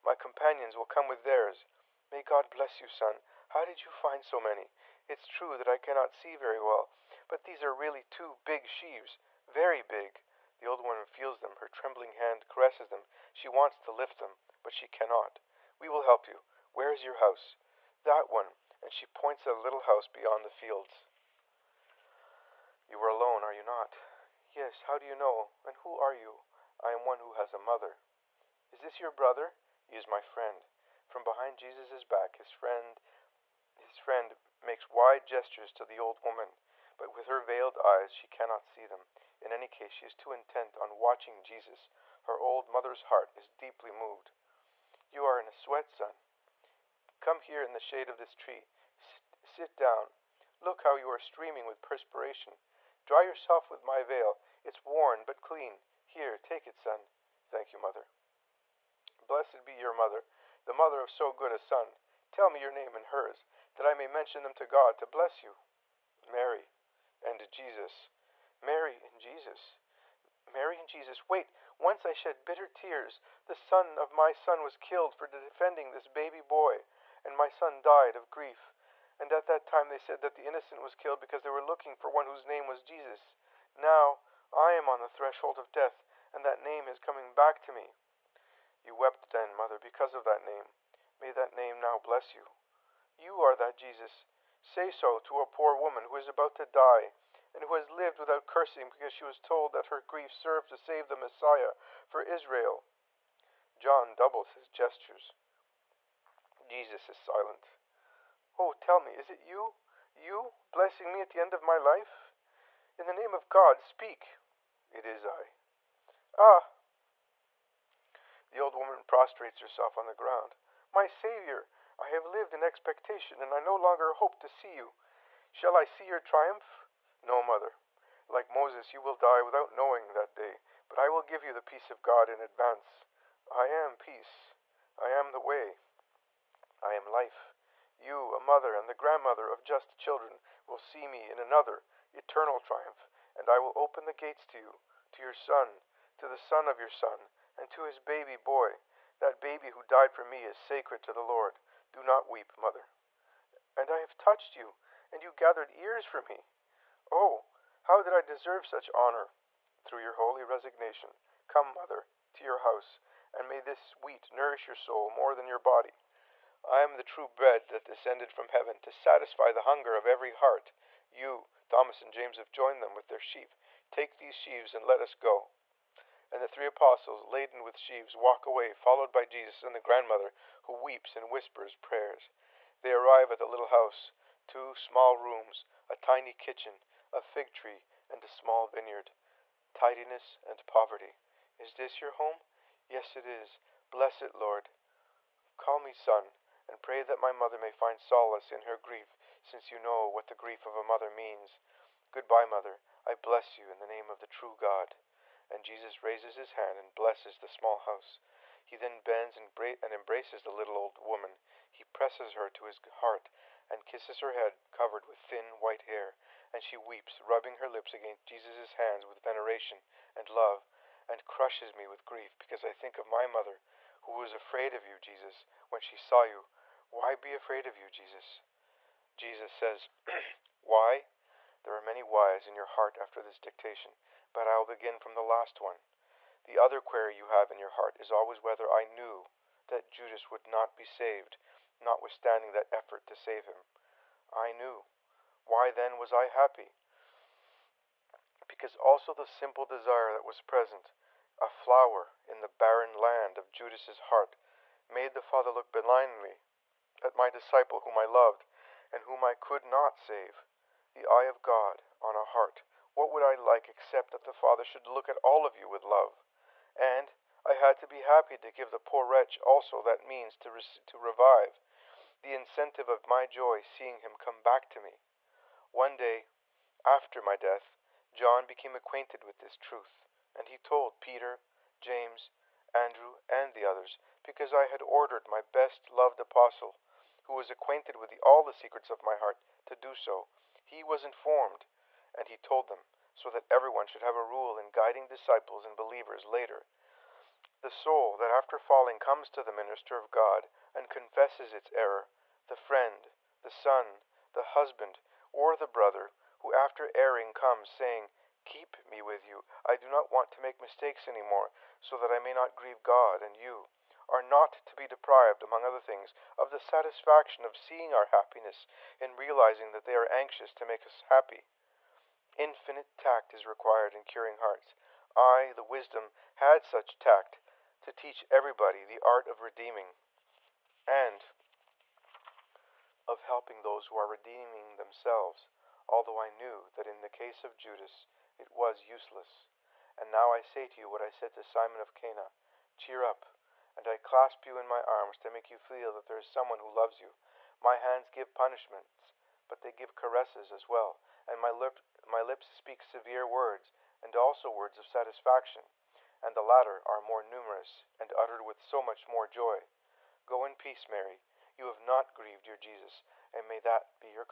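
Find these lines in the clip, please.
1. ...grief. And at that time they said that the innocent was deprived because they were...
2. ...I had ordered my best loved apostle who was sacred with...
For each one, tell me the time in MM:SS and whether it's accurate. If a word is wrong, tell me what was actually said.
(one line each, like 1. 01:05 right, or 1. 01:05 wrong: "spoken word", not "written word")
1. 01:18 wrong: "killed", not "deprived"
2. 04:44 wrong: "acquainted", not "sacred".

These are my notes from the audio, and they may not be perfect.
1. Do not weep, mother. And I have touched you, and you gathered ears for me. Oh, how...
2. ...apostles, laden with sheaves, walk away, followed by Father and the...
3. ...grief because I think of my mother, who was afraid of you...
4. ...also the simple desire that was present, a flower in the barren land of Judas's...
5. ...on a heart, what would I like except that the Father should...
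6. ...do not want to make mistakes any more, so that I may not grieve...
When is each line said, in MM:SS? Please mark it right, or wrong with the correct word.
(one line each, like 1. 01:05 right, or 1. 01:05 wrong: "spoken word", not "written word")
1. 02:31 right
2. 02:56 wrong: "Jesus", not "Father"
3. 03:42 right
4. 04:08 right
5. 04:22 right
6. 05:09 right.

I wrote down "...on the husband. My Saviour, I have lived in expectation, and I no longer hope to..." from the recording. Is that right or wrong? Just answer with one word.
wrong.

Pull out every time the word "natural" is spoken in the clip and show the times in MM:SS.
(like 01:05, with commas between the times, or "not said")
not said.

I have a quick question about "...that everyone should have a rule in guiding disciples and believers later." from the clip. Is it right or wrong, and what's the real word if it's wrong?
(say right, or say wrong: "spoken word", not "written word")
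right.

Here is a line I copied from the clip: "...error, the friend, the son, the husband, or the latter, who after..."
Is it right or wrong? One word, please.
wrong.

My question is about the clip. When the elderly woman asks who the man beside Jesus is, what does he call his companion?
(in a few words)
My friend.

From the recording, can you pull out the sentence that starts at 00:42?
Her old mother's heart is deeply moved.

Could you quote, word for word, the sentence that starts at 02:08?
Like Moses, you will die without knowing that day, but I will give you the peace of God in advance.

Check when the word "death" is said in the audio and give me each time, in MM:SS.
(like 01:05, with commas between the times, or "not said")
01:25, 04:37.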